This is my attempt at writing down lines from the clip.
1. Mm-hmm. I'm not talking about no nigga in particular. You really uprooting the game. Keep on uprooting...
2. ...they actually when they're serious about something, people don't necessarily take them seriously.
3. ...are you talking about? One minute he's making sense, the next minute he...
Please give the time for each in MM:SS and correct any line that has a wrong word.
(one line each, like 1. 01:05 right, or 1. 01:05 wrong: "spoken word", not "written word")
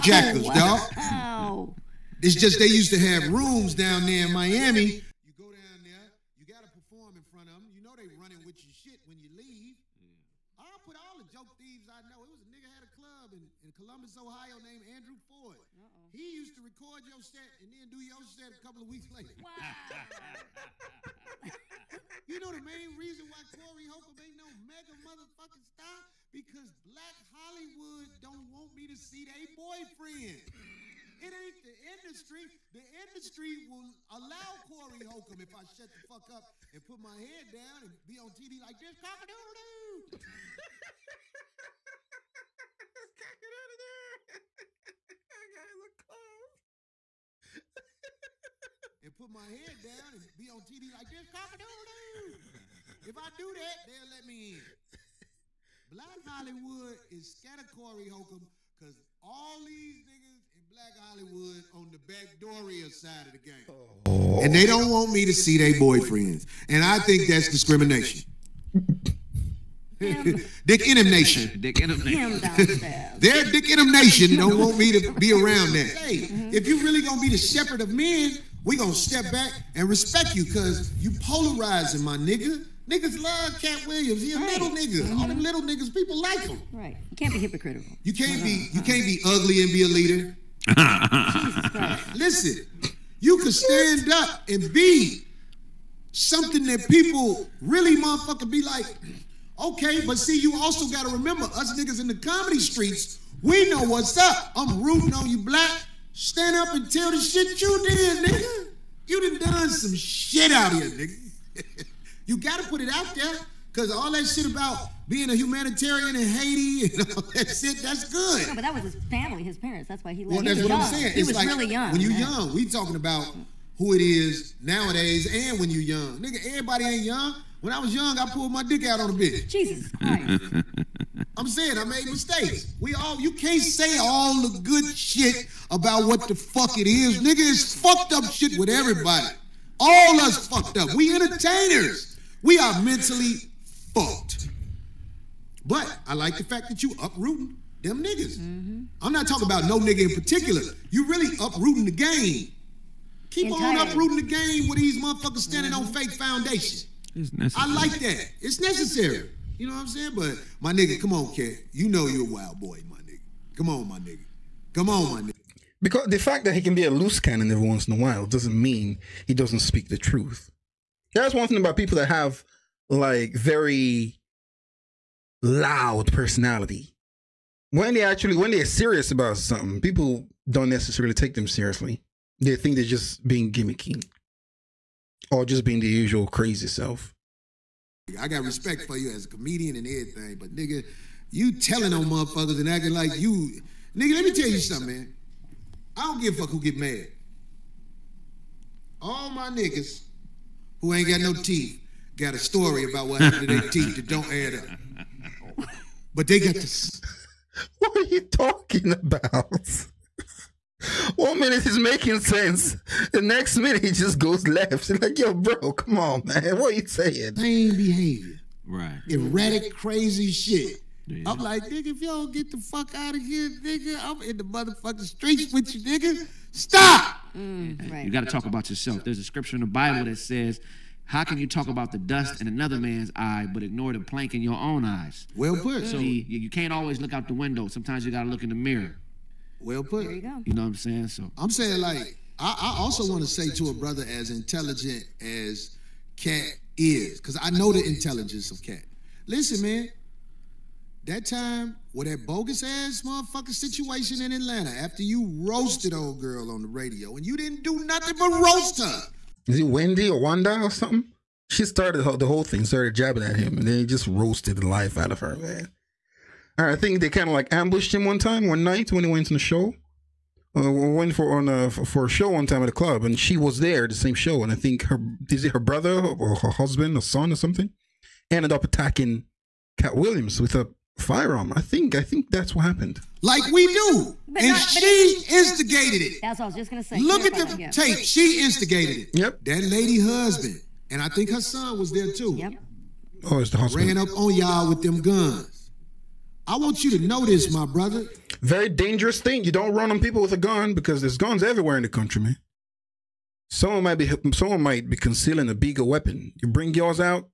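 1. 02:28 right
2. 02:57 right
3. 03:27 right.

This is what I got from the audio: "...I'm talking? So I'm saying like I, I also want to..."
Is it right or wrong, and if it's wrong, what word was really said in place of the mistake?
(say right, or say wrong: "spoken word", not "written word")
wrong: "saying", not "talking".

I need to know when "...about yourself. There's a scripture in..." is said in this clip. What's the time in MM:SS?
03:48.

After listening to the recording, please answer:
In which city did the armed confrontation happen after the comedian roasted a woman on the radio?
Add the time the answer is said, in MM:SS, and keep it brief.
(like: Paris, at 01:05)
Atlanta, at 04:14.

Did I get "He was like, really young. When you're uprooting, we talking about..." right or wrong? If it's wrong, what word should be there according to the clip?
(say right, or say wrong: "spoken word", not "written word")
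wrong: "young", not "uprooting".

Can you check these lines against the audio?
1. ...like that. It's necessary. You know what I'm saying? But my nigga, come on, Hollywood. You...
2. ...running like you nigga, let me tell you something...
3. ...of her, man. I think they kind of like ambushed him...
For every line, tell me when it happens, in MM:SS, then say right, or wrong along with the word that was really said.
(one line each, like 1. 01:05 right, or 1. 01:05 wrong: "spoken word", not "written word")
1. 02:37 wrong: "Katt", not "Hollywood"
2. 03:12 wrong: "acting", not "running"
3. 04:25 right.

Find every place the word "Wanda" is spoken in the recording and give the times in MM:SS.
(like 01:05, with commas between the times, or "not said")
04:20.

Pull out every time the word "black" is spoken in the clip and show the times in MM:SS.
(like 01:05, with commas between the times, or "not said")
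00:26, 00:55, 01:00, 01:45.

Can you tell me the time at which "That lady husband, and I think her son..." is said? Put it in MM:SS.
04:49.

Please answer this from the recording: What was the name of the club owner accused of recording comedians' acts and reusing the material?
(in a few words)
Andrew Ford.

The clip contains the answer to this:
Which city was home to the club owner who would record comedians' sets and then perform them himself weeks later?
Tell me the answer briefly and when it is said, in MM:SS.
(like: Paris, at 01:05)
Columbus, Ohio, at 00:13.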